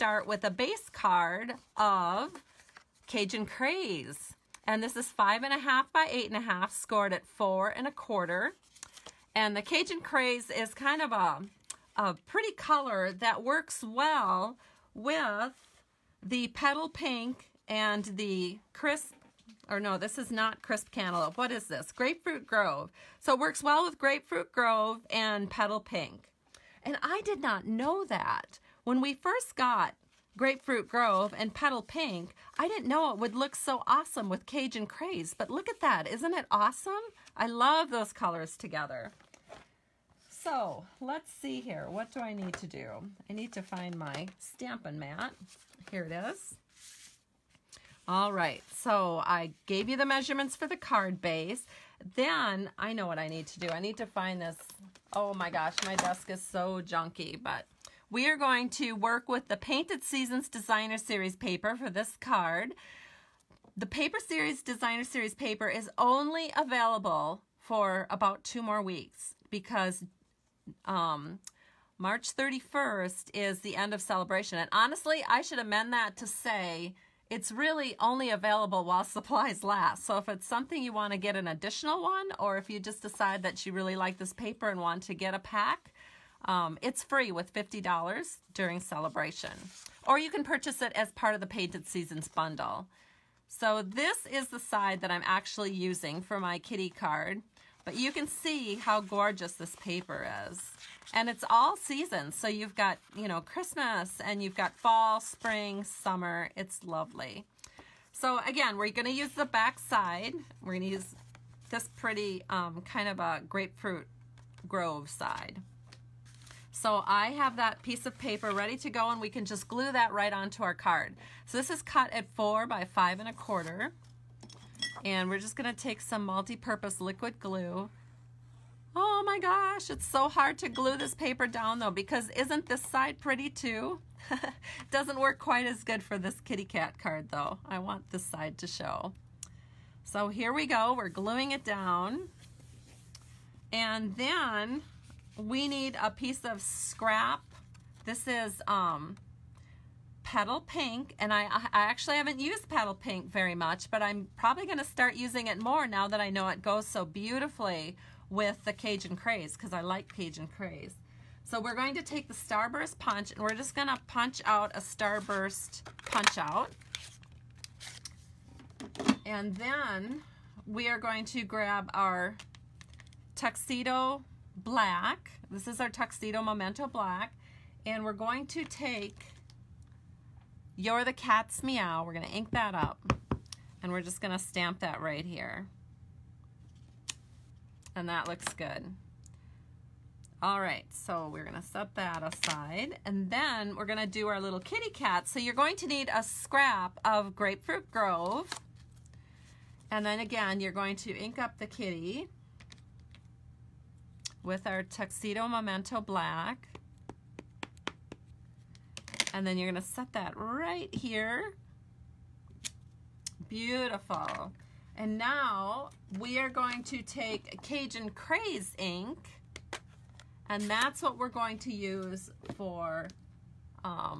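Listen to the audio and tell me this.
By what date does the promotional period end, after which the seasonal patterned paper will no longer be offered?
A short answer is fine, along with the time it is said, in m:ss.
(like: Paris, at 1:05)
March 31st, at 1:11.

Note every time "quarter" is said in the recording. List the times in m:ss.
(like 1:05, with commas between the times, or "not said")
0:07, 2:03.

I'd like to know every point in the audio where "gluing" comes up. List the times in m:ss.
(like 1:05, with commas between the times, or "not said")
2:21.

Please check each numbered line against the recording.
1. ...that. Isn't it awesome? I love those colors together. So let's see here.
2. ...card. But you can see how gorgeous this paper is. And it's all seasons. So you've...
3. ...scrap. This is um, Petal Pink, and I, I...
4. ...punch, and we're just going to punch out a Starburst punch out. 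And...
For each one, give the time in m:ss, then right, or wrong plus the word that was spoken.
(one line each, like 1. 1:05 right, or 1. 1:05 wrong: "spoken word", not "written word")
1. 0:35 right
2. 1:36 right
3. 2:26 right
4. 2:42 right.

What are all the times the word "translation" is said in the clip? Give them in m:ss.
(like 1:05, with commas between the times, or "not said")
not said.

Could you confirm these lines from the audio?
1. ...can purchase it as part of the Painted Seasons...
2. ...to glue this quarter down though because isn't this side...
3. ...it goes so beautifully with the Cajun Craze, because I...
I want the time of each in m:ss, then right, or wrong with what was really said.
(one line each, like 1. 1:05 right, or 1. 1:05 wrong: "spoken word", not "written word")
1. 1:30 right
2. 2:10 wrong: "paper", not "quarter"
3. 2:36 right.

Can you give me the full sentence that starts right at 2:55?
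This is our Tuxedo Memento Black.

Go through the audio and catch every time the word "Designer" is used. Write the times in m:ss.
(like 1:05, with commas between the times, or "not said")
1:00, 1:04.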